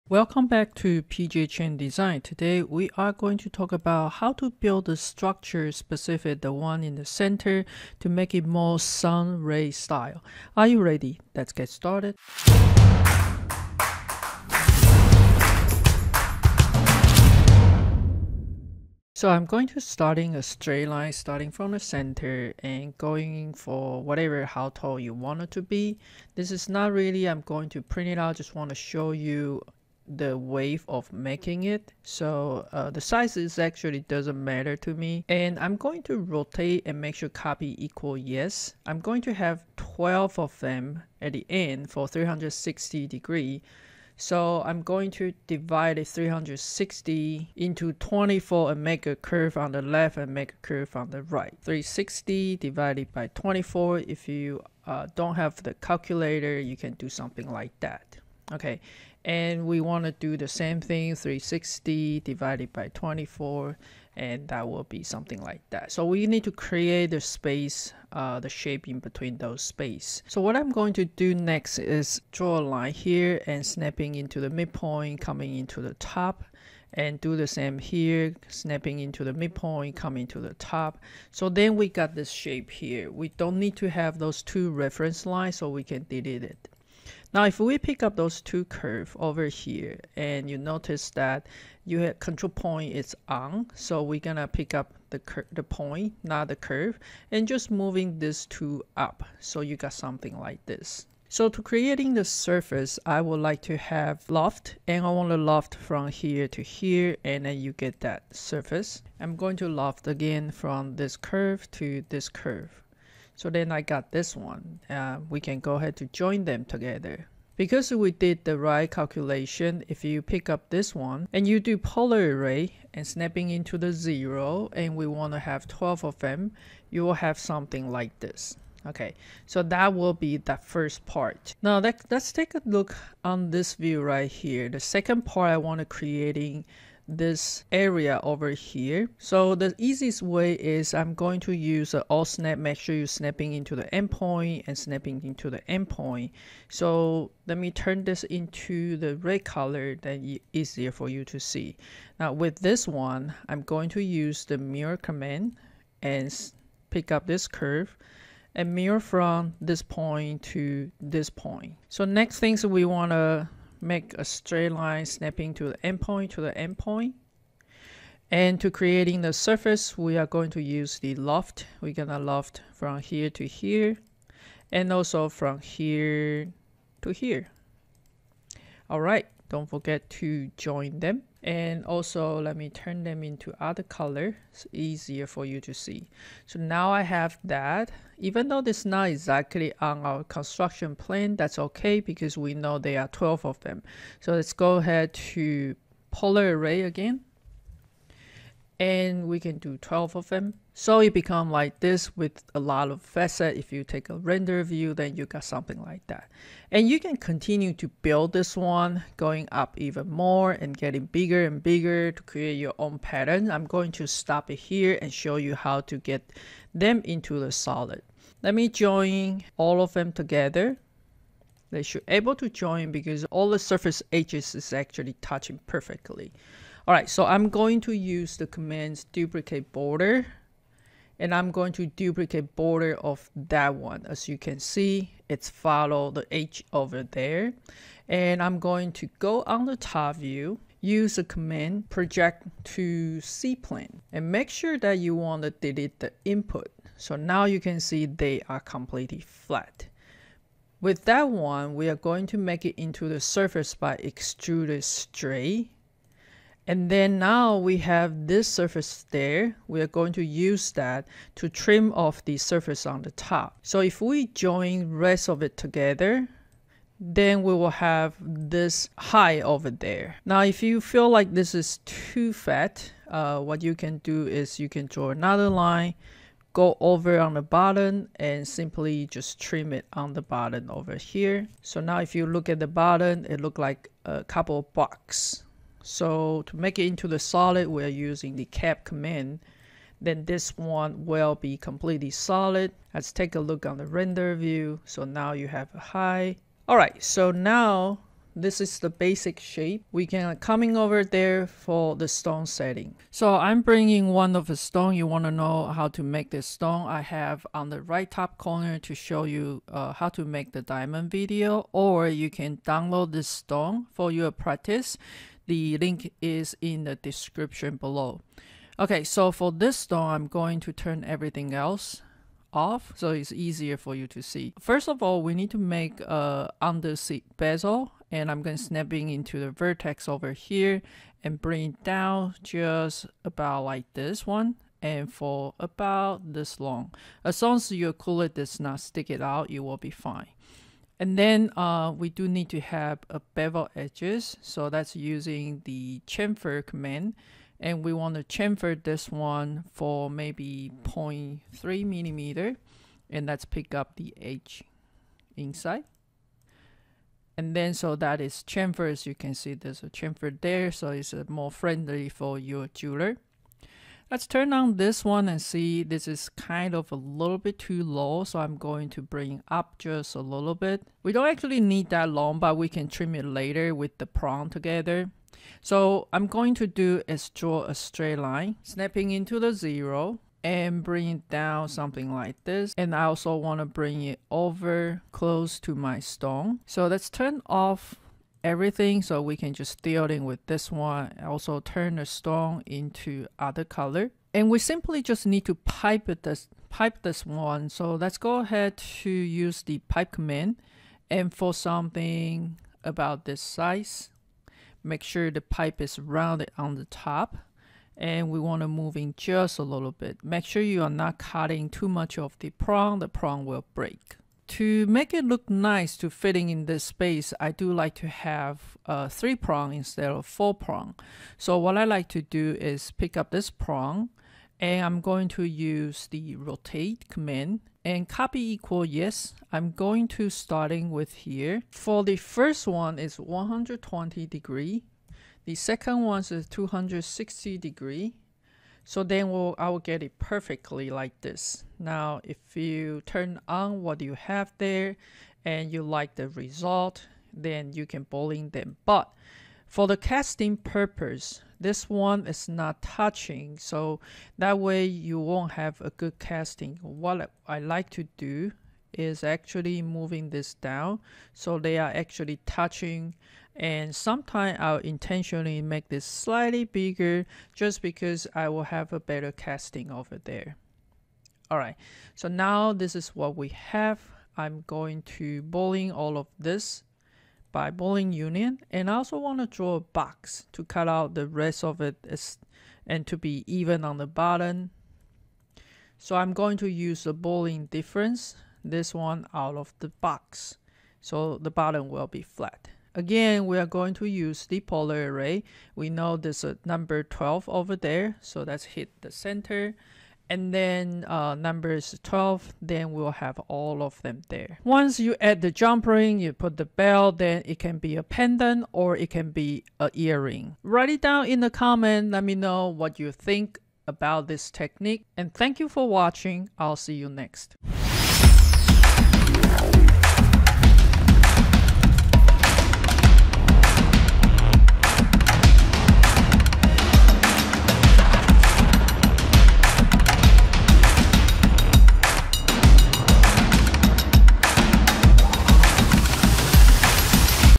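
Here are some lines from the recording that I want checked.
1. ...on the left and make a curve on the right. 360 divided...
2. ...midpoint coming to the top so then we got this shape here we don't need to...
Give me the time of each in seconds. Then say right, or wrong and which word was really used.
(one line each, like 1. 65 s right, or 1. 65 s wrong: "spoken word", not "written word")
1. 49 s right
2. 79 s right.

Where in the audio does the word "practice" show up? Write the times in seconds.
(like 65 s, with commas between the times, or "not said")
314 s.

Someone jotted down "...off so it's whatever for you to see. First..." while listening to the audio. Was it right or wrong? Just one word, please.
wrong.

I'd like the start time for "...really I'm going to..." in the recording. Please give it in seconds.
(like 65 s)
26 s.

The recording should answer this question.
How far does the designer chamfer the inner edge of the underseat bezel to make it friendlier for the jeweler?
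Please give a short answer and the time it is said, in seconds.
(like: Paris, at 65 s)
0.3 millimeter, at 350 s.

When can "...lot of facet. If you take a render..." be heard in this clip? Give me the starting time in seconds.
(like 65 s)
202 s.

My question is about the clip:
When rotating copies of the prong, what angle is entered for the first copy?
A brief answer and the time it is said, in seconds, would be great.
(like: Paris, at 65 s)
120 degrees, at 433 s.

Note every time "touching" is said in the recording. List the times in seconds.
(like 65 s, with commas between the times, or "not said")
225 s, 452 s, 462 s.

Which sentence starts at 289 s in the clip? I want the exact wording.
Then this one will be completely solid.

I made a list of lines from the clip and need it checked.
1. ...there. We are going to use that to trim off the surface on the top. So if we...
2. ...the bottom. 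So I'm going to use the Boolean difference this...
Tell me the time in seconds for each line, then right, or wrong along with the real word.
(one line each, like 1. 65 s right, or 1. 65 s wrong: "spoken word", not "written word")
1. 259 s right
2. 483 s right.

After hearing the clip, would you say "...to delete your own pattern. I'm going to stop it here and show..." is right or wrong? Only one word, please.
wrong.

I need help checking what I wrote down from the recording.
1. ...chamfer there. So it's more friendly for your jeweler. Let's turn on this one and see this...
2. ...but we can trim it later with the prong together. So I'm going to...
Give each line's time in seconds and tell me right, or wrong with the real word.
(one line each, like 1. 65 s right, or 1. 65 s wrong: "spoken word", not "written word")
1. 359 s right
2. 372 s right.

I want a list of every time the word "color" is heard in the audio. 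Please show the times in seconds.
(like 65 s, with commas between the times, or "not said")
149 s, 183 s, 393 s.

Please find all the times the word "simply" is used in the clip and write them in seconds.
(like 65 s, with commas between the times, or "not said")
278 s, 394 s.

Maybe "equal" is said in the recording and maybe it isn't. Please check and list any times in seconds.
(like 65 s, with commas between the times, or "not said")
37 s, 428 s.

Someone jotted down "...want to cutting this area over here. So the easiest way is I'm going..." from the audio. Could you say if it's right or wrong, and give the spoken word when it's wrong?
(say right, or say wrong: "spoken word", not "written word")
wrong: "creating", not "cutting".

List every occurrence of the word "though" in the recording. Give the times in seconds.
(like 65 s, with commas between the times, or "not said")
188 s.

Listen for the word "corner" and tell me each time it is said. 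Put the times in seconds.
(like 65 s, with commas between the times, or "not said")
308 s.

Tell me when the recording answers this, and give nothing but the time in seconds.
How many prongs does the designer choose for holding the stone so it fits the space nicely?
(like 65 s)
419 s.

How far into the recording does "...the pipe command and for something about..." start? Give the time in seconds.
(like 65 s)
399 s.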